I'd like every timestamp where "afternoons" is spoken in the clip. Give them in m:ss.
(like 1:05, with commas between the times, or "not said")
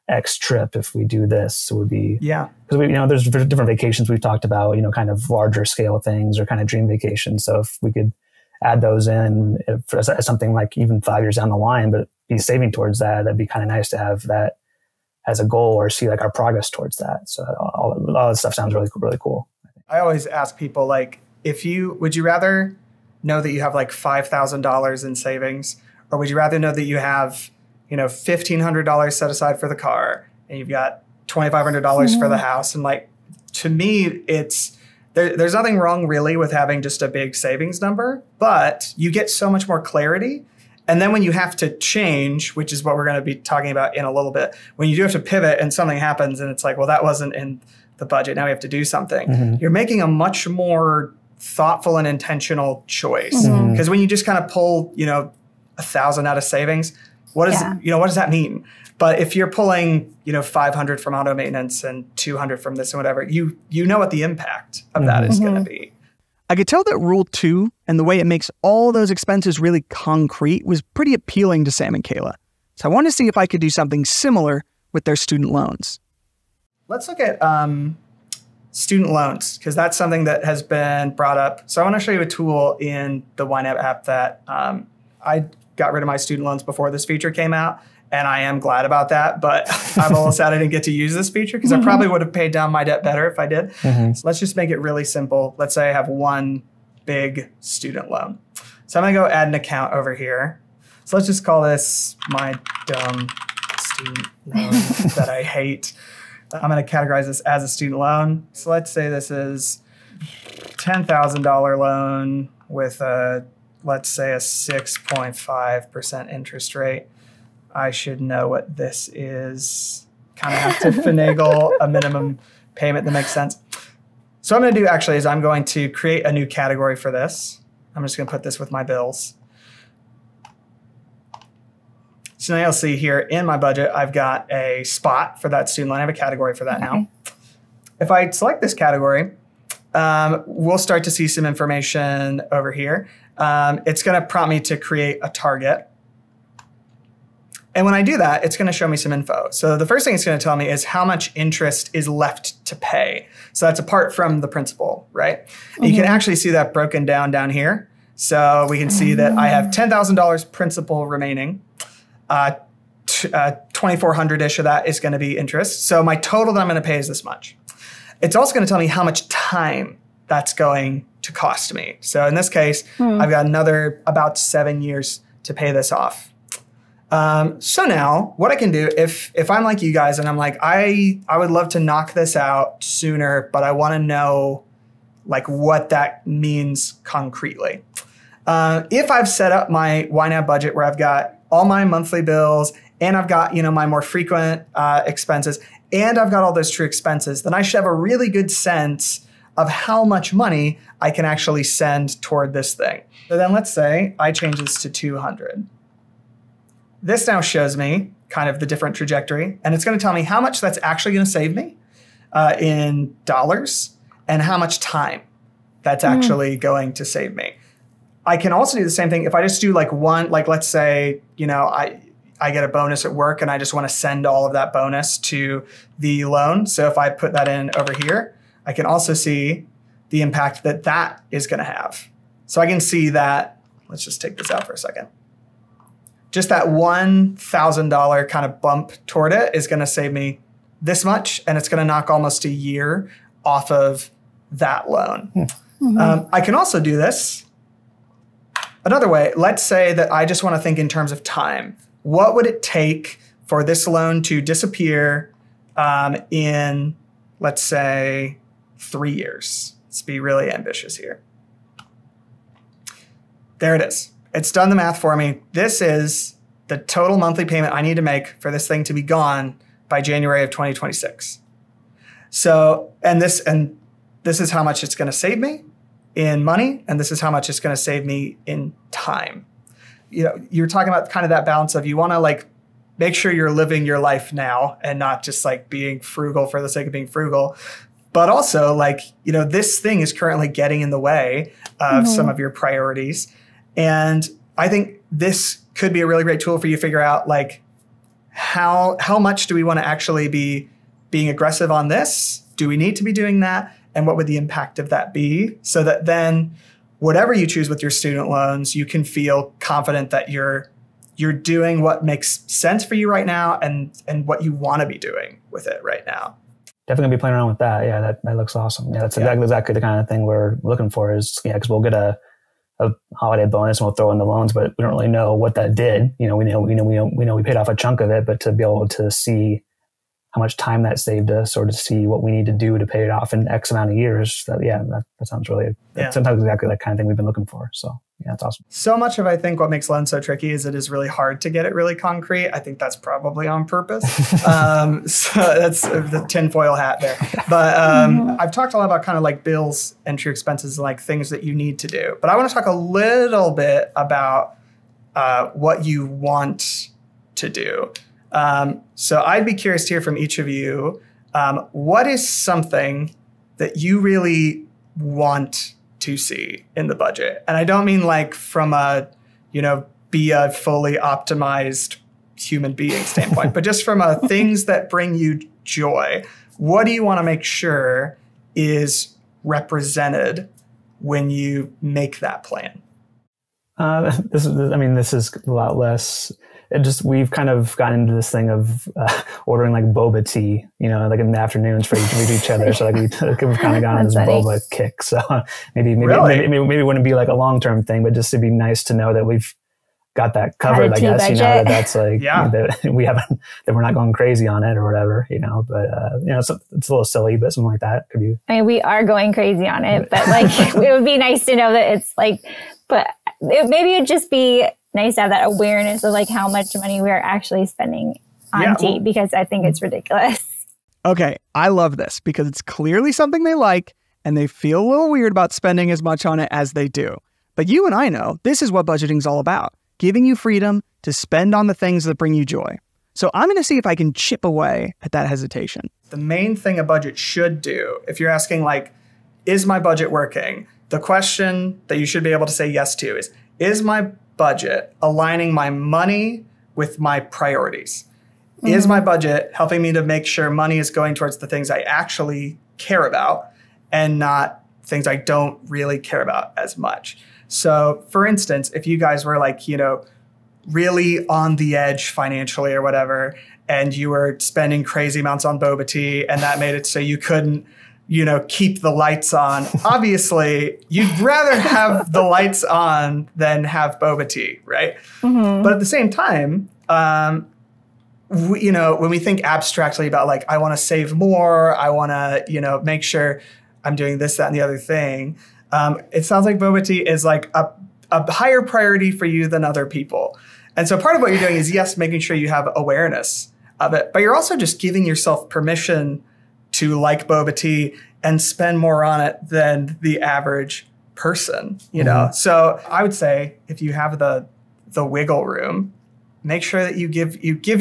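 6:31.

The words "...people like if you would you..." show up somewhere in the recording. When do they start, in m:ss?
0:20.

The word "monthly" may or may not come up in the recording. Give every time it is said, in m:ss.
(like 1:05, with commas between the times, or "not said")
3:11, 4:27.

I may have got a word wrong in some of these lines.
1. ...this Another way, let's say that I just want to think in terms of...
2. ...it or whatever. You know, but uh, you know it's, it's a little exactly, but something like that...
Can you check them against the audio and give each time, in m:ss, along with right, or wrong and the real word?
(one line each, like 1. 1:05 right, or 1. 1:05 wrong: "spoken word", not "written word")
1. 4:07 right
2. 6:44 wrong: "silly", not "exactly".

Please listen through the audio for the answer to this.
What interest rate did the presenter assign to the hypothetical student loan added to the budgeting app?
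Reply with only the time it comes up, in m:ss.
1:54.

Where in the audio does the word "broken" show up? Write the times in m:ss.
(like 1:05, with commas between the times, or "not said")
2:36.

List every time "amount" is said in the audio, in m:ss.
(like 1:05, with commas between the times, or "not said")
5:33, 7:45.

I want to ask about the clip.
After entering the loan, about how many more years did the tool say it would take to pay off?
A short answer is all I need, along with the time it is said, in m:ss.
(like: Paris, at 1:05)
7, at 2:54.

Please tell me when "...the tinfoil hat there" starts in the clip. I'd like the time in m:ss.
5:45.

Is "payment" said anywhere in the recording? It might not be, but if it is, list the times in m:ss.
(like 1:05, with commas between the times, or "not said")
2:02, 4:27.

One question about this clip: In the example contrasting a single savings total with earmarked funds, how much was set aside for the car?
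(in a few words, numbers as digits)
$1,500.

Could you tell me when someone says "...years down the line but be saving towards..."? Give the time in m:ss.
0:11.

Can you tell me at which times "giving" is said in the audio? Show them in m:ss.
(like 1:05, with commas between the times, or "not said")
7:09, 8:14.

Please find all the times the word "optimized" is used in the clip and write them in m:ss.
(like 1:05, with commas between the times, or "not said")
6:10.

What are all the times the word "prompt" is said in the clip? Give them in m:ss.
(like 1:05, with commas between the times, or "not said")
2:24.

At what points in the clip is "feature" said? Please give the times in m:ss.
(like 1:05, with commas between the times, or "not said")
1:27, 1:31.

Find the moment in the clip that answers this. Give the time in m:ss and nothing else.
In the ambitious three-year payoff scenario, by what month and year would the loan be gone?
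4:29.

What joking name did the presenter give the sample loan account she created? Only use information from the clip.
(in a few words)
dumb student loan.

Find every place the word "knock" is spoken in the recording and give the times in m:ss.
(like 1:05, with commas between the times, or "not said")
3:01, 4:01.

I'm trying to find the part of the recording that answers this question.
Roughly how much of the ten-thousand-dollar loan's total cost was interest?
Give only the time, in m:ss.
2:43.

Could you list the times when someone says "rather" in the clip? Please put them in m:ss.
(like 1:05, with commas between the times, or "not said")
0:22, 0:26, 7:51.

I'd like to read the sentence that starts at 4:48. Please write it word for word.
But also, like, you know, this thing is currently getting in the way of mm-hmm.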